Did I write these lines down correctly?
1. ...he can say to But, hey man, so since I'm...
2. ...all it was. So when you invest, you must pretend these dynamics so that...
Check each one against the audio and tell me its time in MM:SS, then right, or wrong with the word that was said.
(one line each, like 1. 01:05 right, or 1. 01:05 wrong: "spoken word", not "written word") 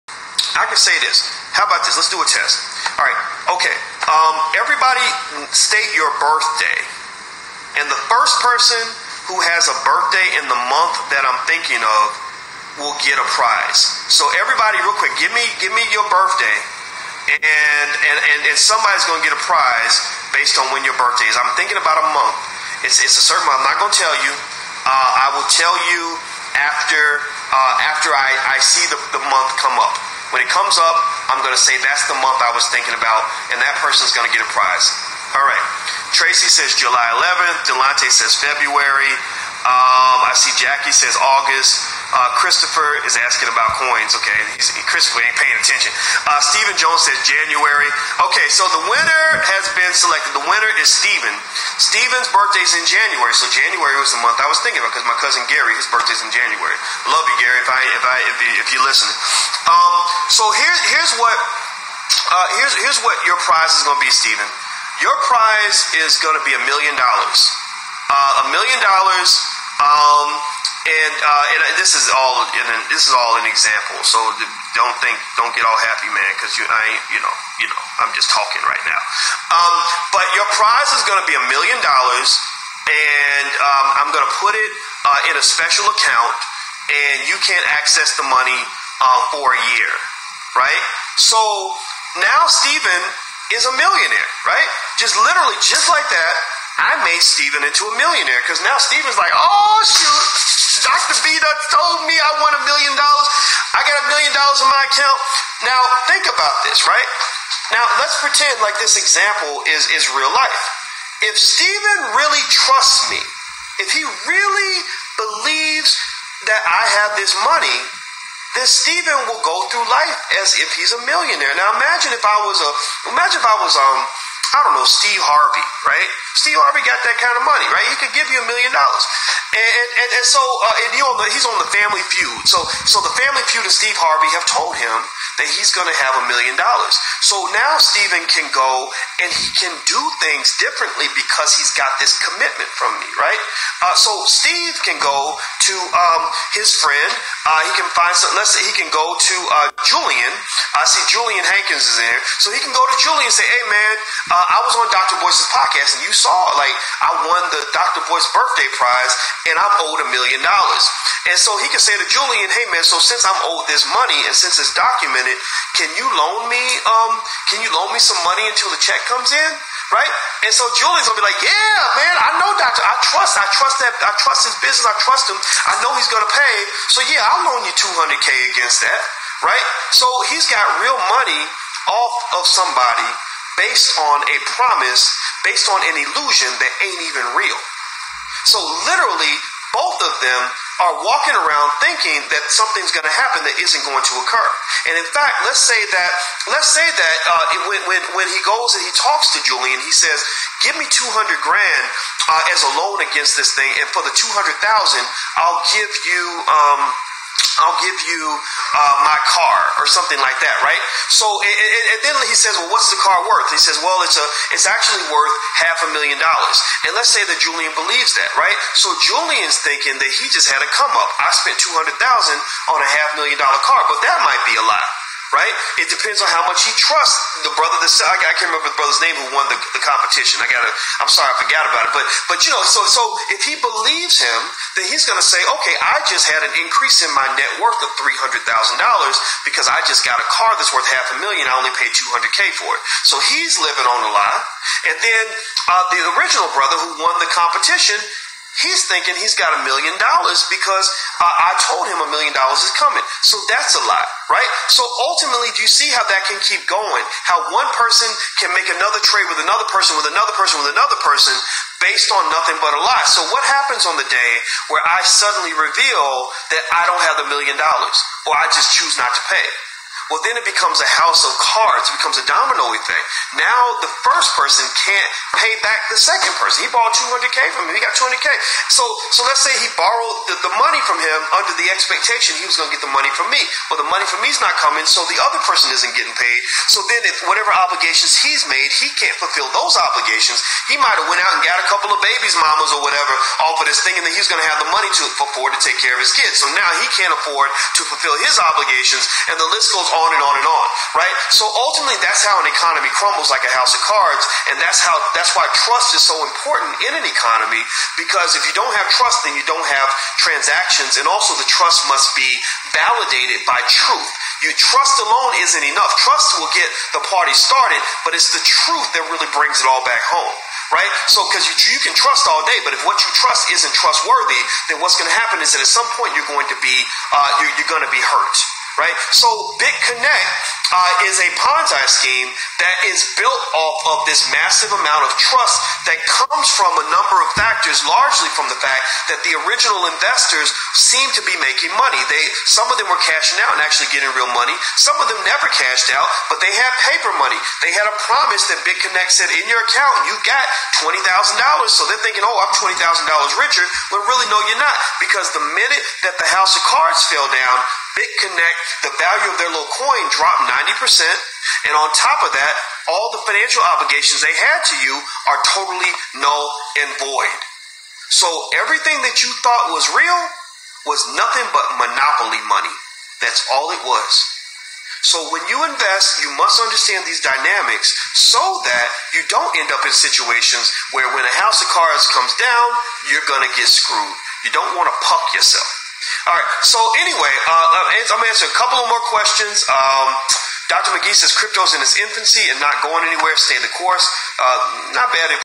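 1. 02:41 wrong: "Julian", not "But"
2. 06:13 wrong: "understand", not "pretend".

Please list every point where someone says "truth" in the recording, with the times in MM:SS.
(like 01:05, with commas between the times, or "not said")
05:13, 05:18.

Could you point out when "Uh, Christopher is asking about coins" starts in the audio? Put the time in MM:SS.
00:42.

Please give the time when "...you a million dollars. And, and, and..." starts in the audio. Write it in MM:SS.
02:08.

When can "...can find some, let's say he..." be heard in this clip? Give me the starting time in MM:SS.
02:27.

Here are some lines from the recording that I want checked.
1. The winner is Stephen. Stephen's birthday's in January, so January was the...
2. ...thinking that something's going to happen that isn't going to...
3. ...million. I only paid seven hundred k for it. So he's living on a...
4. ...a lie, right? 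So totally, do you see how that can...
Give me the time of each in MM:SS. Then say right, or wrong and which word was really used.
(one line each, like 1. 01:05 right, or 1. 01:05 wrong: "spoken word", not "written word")
1. 00:50 right
2. 03:11 right
3. 04:01 wrong: "two", not "seven"
4. 04:13 wrong: "ultimately", not "totally".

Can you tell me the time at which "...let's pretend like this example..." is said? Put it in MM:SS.
01:48.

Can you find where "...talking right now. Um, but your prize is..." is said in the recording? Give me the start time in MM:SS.
01:18.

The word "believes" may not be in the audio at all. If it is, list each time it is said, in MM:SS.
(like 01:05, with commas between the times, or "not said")
01:55, 03:37, 03:53.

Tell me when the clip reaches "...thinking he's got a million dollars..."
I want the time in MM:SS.
04:08.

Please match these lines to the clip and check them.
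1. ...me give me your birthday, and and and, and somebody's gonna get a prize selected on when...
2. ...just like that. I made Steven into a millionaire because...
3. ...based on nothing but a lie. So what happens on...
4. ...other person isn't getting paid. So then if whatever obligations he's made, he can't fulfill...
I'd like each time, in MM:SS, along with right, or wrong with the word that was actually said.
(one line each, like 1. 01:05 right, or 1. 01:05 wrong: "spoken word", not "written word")
1. 00:15 wrong: "based", not "selected"
2. 01:35 right
3. 04:21 right
4. 04:45 right.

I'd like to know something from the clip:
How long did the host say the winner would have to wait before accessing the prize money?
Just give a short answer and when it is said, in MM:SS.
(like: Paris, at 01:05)
a year, at 01:29.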